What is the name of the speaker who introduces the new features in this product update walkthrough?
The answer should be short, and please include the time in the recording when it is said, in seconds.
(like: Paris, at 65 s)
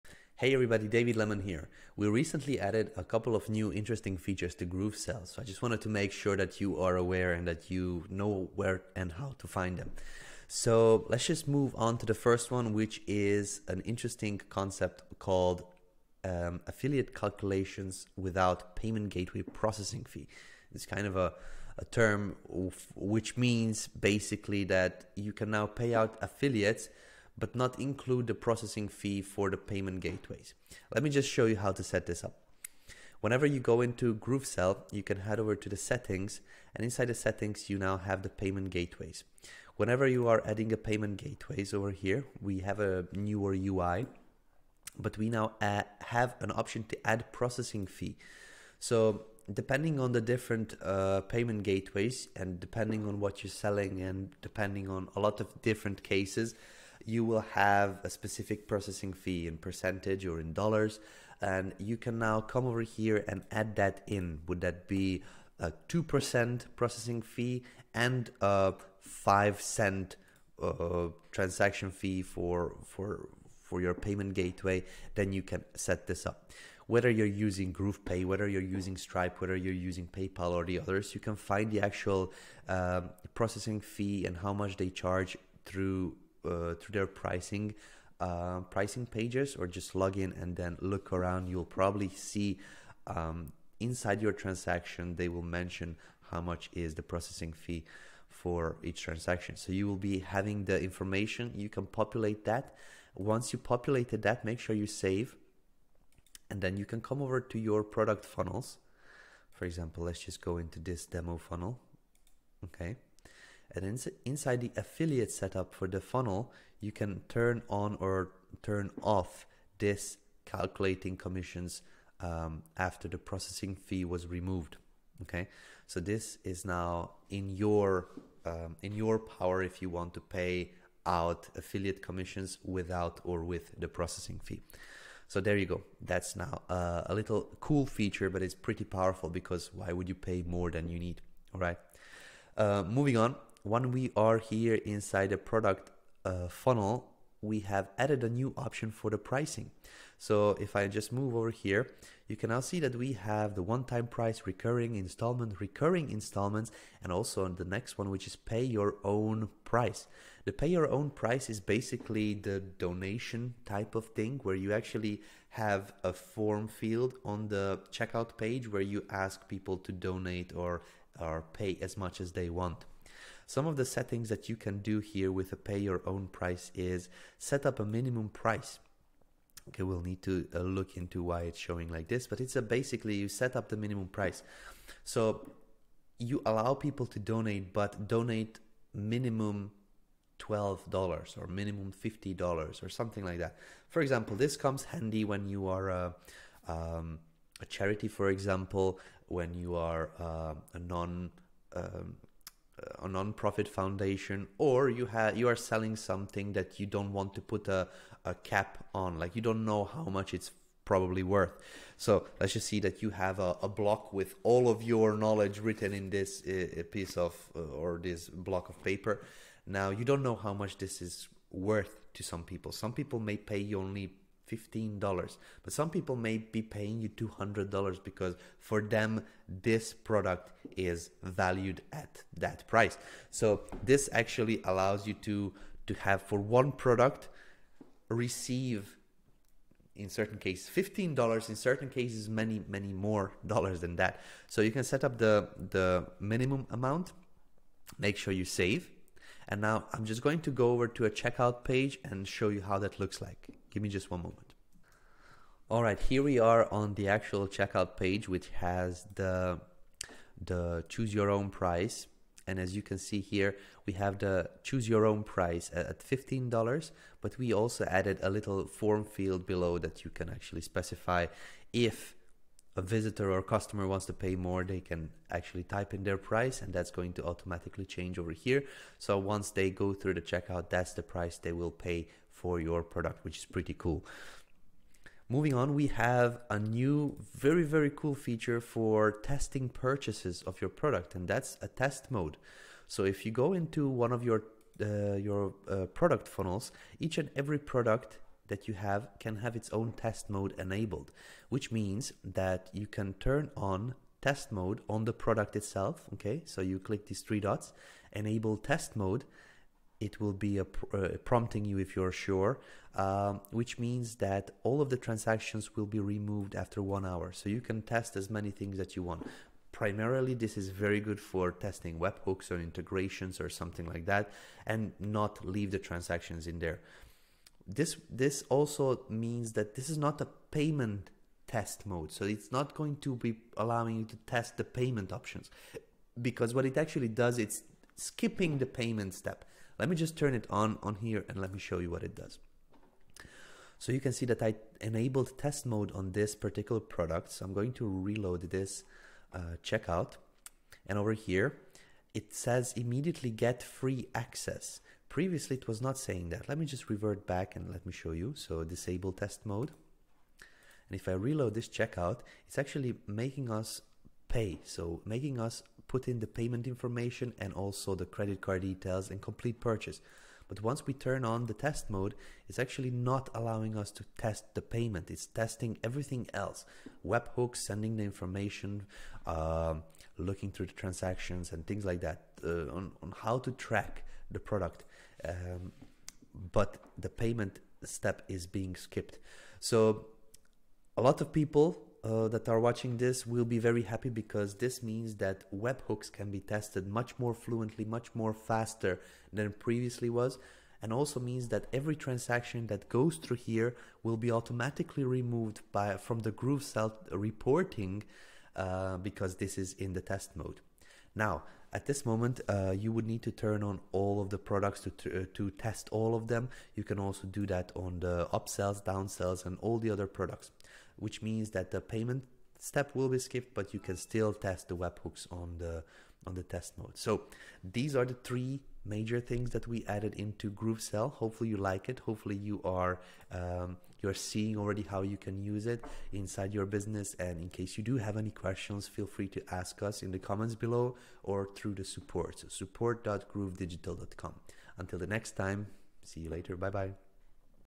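David Lemon, at 0 s.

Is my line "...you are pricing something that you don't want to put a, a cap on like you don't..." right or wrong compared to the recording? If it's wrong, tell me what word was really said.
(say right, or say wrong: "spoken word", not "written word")
wrong: "selling", not "pricing".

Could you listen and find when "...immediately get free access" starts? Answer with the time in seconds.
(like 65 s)
352 s.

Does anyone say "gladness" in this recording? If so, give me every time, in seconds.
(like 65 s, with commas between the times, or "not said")
not said.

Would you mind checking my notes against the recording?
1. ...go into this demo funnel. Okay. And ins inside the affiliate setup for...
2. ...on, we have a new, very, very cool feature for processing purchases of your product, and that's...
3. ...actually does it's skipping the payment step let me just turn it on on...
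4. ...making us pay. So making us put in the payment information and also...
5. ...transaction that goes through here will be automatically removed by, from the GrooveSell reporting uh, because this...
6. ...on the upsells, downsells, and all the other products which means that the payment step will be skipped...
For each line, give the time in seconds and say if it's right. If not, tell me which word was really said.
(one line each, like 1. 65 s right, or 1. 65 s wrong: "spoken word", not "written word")
1. 110 s right
2. 285 s wrong: "testing", not "processing"
3. 336 s right
4. 363 s right
5. 401 s right
6. 417 s right.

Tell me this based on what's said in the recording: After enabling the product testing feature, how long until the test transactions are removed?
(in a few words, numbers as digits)
one hour.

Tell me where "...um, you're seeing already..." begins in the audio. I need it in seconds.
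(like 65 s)
433 s.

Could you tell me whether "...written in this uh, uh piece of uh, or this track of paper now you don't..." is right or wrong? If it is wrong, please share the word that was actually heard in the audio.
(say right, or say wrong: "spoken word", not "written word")
wrong: "block", not "track".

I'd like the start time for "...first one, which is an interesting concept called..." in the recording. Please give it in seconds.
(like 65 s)
12 s.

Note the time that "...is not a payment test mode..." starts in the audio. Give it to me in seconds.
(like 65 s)
329 s.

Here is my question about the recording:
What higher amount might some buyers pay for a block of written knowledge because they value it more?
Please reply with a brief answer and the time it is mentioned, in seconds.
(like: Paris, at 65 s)
$200, at 227 s.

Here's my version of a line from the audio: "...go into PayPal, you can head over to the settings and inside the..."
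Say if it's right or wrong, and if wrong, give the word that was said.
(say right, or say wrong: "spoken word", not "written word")
wrong: "GrooveSell", not "PayPal".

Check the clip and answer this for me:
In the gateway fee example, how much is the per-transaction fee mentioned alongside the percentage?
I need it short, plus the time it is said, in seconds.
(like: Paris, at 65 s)
5 cents, at 69 s.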